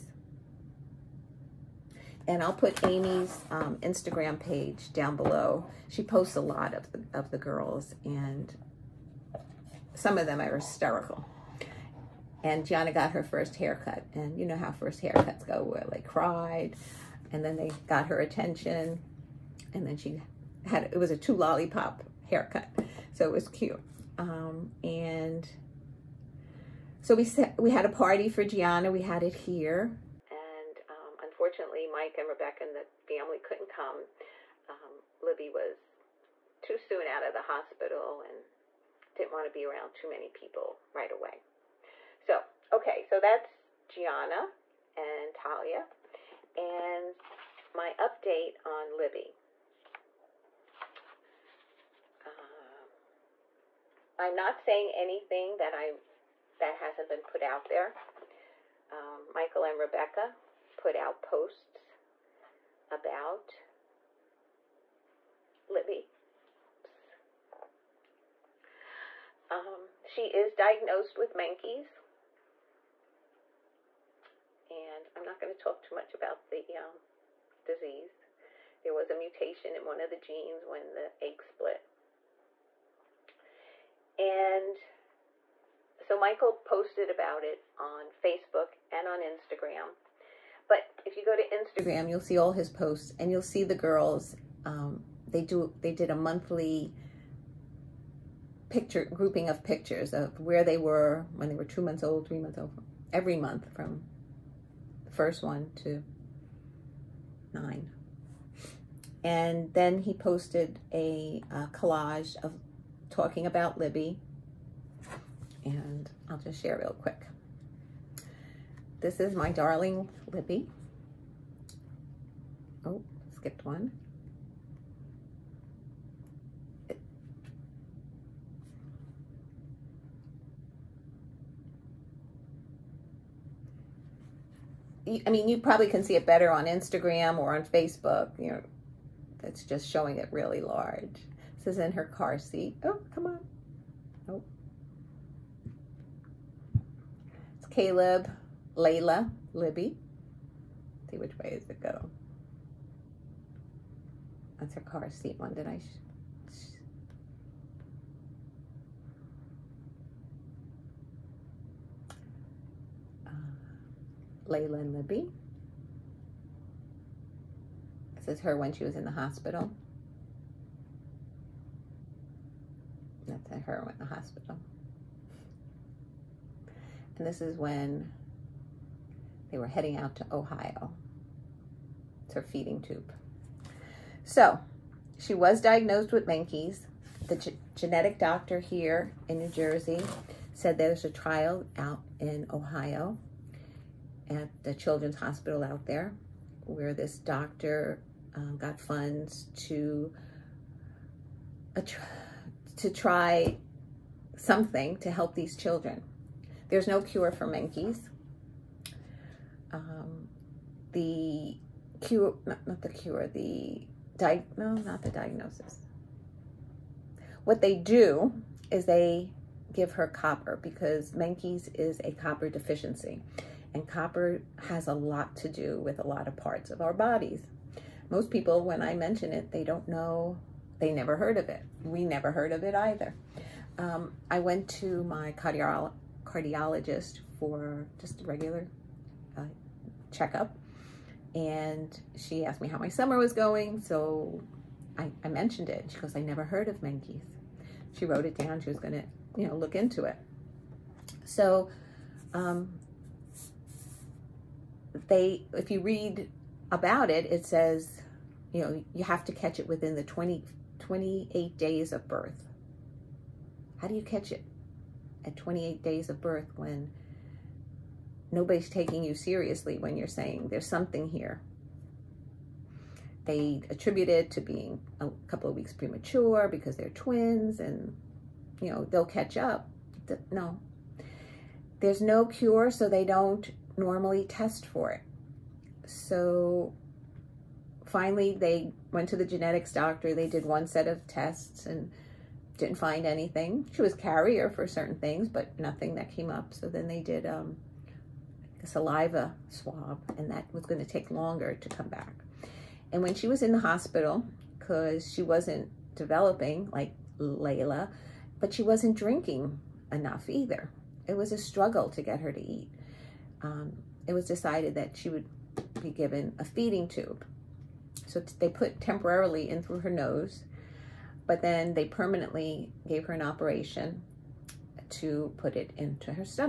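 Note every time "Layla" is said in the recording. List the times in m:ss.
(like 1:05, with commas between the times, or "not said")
2:28, 2:44, 5:07.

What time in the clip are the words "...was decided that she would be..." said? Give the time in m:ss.
5:14.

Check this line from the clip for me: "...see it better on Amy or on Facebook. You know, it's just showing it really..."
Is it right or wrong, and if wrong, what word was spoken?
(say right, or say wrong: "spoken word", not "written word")
wrong: "Instagram", not "Amy".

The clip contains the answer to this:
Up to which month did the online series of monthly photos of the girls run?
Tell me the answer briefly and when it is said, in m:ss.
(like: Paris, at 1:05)
9, at 1:47.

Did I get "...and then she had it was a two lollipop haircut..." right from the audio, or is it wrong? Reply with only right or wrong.
right.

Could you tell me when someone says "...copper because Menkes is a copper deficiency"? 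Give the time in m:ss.
3:40.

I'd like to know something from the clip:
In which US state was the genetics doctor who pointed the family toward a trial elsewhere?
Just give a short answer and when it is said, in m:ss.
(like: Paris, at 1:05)
New Jersey, at 3:09.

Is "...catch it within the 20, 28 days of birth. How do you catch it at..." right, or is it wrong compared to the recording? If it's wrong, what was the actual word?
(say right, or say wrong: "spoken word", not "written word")
right.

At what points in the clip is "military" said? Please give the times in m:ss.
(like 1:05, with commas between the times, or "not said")
not said.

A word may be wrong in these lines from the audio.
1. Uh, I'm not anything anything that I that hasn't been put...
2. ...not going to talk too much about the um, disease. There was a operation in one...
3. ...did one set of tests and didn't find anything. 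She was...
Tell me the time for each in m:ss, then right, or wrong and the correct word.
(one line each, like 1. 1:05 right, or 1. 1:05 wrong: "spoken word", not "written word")
1. 0:52 wrong: "saying", not "anything"
2. 1:15 wrong: "mutation", not "operation"
3. 4:50 right.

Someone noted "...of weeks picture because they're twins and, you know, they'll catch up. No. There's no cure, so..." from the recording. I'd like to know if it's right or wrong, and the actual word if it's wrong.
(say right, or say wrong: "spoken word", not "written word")
wrong: "premature", not "picture".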